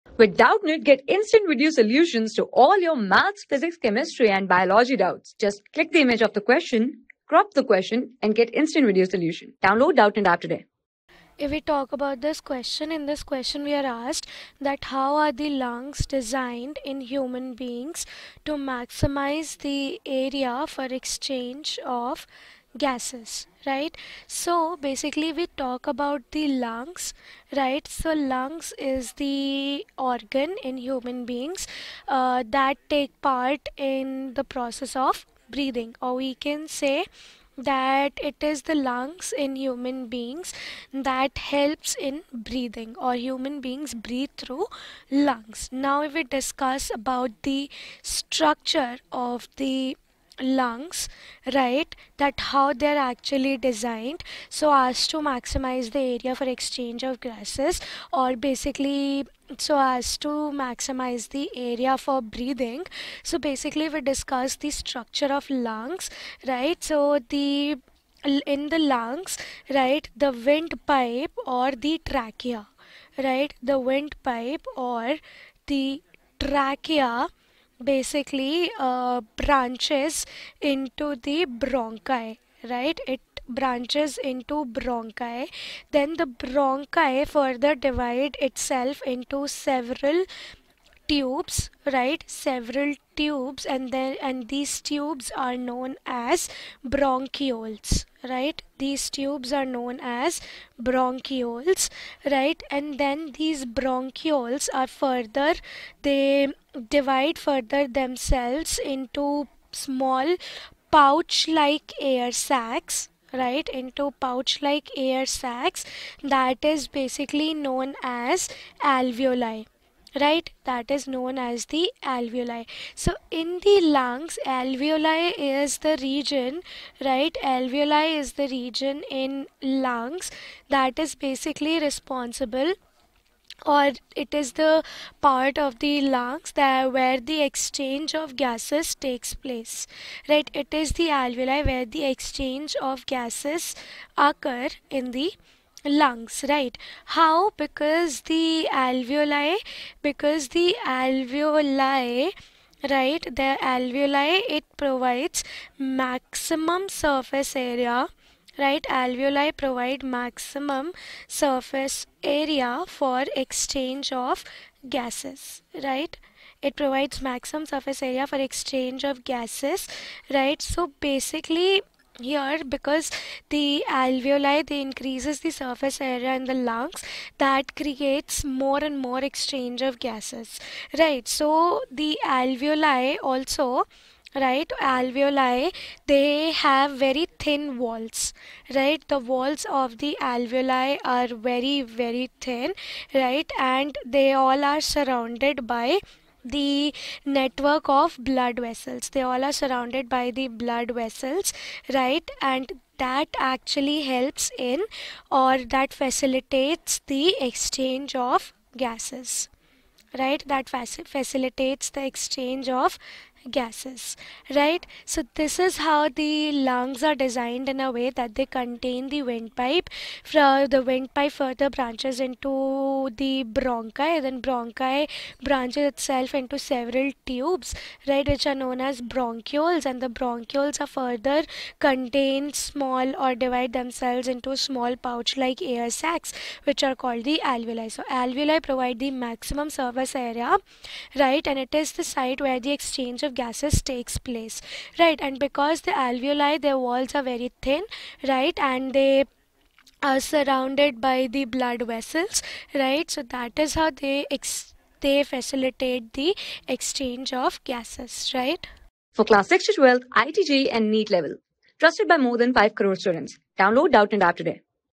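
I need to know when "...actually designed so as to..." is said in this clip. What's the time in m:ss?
0:52.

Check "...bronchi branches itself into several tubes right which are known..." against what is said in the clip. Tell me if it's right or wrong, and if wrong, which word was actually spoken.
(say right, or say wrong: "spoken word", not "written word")
right.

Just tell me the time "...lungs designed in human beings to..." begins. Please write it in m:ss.
0:15.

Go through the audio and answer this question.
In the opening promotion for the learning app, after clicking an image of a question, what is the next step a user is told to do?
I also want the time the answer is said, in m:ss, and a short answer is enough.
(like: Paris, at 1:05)
Crop the question, at 0:07.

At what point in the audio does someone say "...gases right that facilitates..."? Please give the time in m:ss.
3:28.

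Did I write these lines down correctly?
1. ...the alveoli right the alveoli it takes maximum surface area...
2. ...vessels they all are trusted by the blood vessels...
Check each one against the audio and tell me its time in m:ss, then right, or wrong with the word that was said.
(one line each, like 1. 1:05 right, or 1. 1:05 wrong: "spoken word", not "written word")
1. 2:30 wrong: "provides", not "takes"
2. 3:18 wrong: "surrounded", not "trusted".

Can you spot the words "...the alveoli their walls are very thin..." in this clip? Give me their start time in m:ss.
4:05.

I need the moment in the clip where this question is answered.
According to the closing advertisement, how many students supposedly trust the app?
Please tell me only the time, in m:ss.
4:22.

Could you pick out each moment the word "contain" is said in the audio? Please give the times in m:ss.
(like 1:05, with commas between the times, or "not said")
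3:38, 3:51.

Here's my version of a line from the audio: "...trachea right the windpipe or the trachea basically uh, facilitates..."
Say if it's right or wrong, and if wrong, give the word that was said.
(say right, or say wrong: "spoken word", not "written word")
wrong: "branches", not "facilitates".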